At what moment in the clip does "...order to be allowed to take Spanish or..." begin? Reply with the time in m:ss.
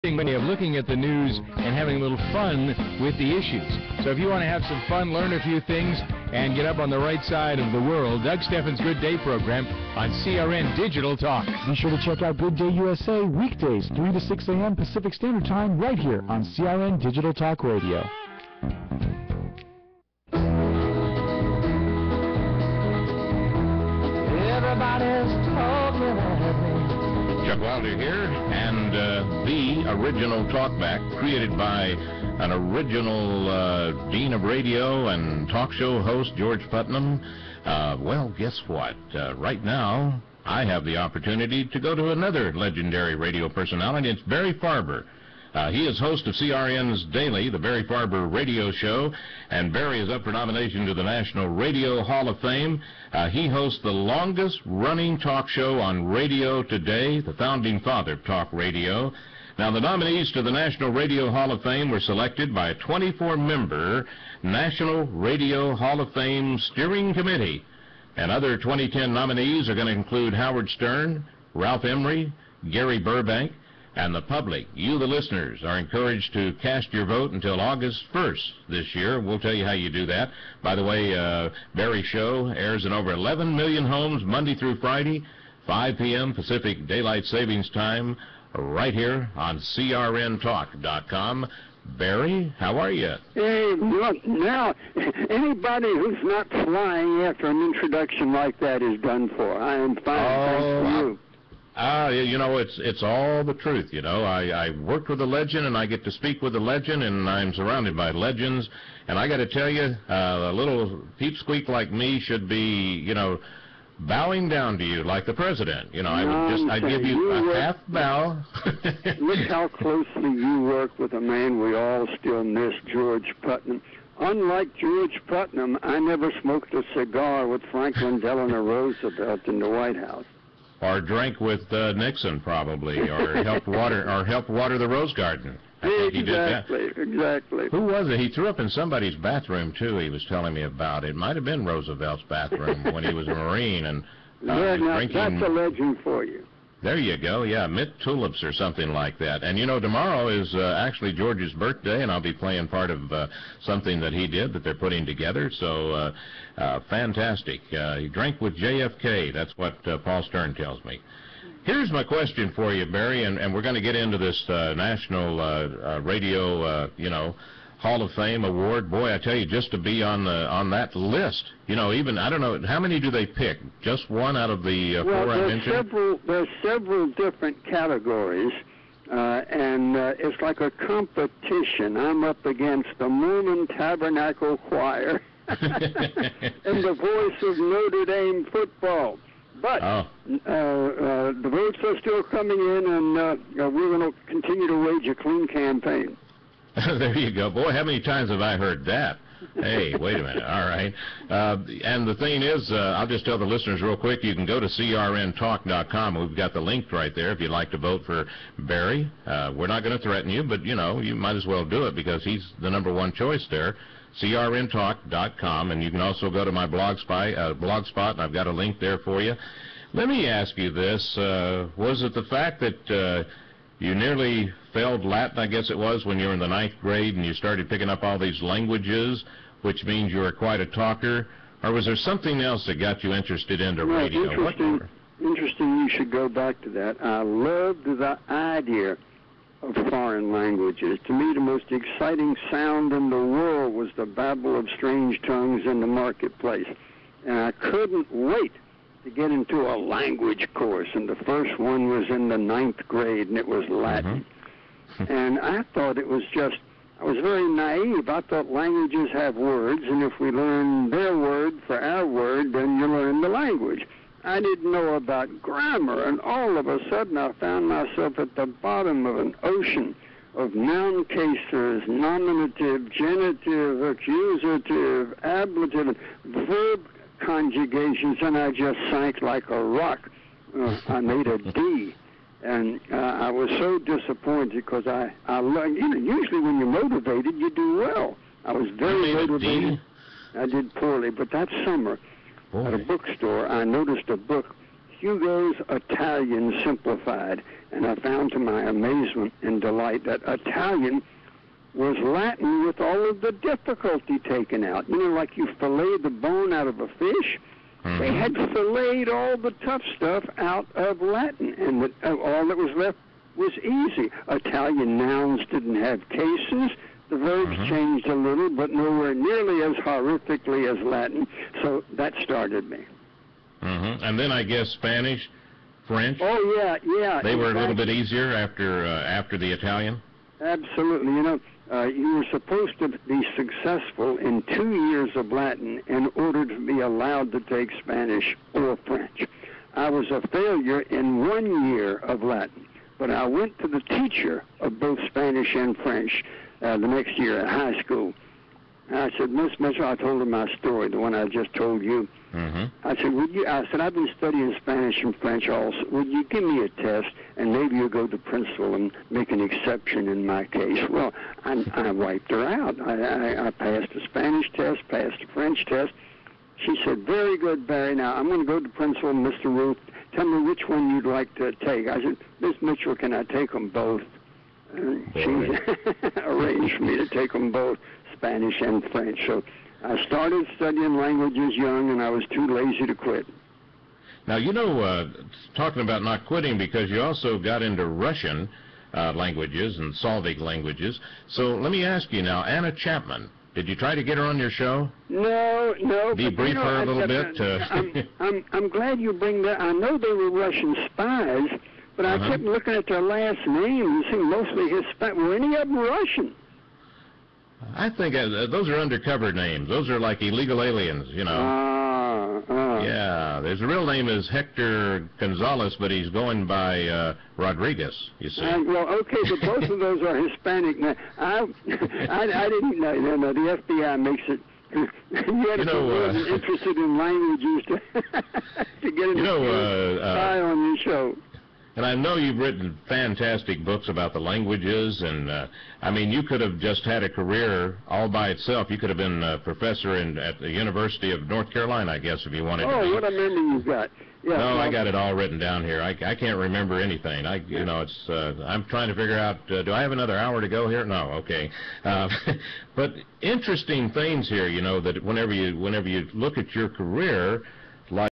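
5:36.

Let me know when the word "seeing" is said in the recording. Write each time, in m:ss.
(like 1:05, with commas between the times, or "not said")
6:44.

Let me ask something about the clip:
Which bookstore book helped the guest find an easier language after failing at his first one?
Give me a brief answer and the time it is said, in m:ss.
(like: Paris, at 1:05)
Hugo's Italian Simplified, at 4:54.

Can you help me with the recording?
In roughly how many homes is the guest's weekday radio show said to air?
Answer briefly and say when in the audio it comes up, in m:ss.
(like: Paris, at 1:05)
11 million, at 1:23.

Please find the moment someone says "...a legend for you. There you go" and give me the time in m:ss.
2:25.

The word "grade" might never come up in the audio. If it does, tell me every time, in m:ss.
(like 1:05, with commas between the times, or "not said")
3:46, 4:12.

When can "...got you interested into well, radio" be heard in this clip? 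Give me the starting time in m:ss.
3:52.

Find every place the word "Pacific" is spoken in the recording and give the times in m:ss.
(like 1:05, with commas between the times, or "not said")
0:14, 1:26.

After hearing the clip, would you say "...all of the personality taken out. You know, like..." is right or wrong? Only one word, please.
wrong.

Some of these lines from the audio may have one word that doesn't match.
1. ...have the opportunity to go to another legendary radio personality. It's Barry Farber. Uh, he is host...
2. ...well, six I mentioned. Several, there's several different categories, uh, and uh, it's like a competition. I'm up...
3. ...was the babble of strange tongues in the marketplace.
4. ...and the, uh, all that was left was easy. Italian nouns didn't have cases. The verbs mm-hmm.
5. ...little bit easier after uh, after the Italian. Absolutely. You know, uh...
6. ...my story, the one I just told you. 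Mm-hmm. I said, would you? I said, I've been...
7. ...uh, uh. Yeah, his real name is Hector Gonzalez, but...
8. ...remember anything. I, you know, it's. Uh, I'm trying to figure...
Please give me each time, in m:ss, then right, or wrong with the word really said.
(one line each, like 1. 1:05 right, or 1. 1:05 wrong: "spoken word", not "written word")
1. 0:40 right
2. 2:55 wrong: "four", not "six"
3. 4:03 right
4. 5:11 right
5. 5:27 right
6. 5:50 right
7. 6:52 right
8. 7:26 right.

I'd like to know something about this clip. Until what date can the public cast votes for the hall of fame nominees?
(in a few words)
August 1st.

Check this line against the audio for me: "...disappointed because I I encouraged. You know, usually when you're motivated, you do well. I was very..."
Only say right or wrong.
wrong.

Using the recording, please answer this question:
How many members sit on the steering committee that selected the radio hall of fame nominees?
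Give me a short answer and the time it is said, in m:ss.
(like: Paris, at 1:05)
24, at 1:02.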